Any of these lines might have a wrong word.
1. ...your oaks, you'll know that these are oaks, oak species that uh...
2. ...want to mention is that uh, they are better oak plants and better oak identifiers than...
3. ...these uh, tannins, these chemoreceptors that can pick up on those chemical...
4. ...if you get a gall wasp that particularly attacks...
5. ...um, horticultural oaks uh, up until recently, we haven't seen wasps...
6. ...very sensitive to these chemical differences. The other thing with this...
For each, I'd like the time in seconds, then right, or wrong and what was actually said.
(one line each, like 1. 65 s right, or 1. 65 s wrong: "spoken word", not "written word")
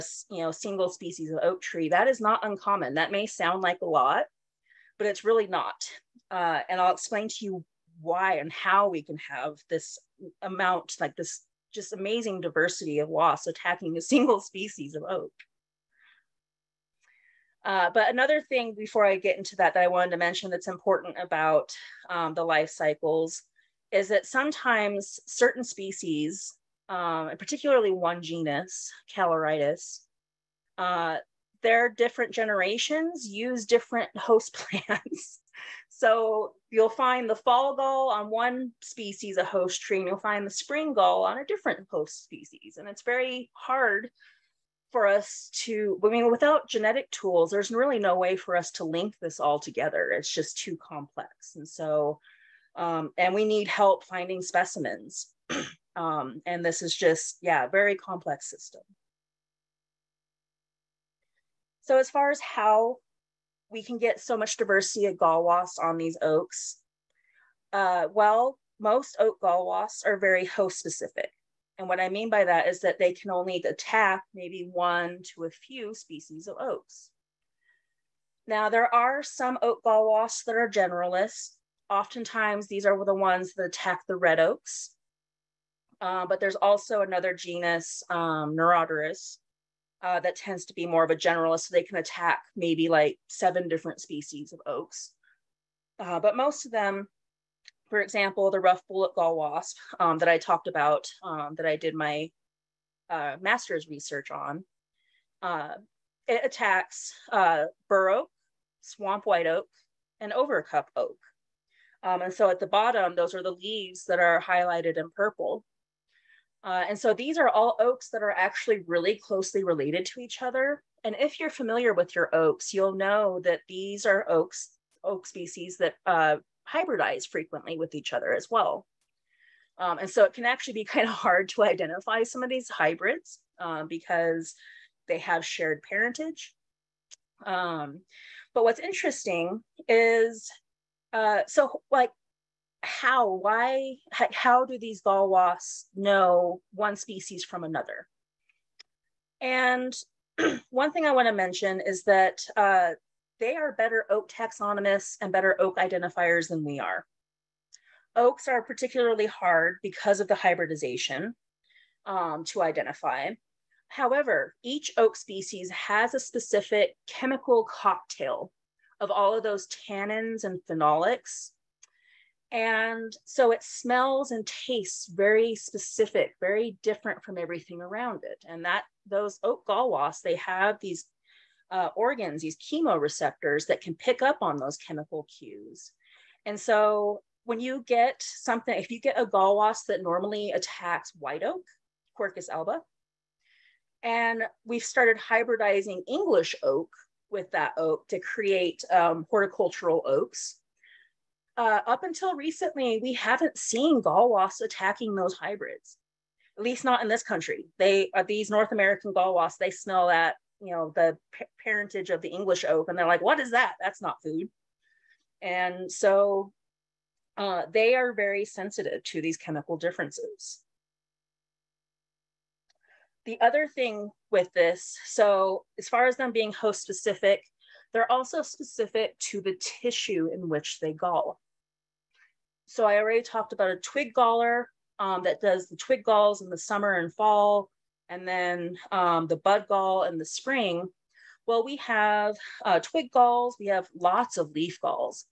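1. 122 s right
2. 151 s wrong: "taxonomists", not "plants"
3. 180 s wrong: "organs", not "tannins"
4. 188 s wrong: "normally", not "particularly"
5. 198 s right
6. 218 s right.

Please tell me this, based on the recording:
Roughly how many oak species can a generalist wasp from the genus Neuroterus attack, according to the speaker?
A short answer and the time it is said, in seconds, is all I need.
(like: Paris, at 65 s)
7, at 93 s.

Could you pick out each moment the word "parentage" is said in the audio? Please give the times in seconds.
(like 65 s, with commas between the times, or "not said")
135 s, 211 s.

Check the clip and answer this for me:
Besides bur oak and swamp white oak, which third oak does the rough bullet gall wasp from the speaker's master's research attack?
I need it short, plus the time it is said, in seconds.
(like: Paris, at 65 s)
Overcup oak, at 110 s.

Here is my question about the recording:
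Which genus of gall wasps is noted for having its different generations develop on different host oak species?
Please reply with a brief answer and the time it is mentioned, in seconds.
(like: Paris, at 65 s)
Callirhytis, at 29 s.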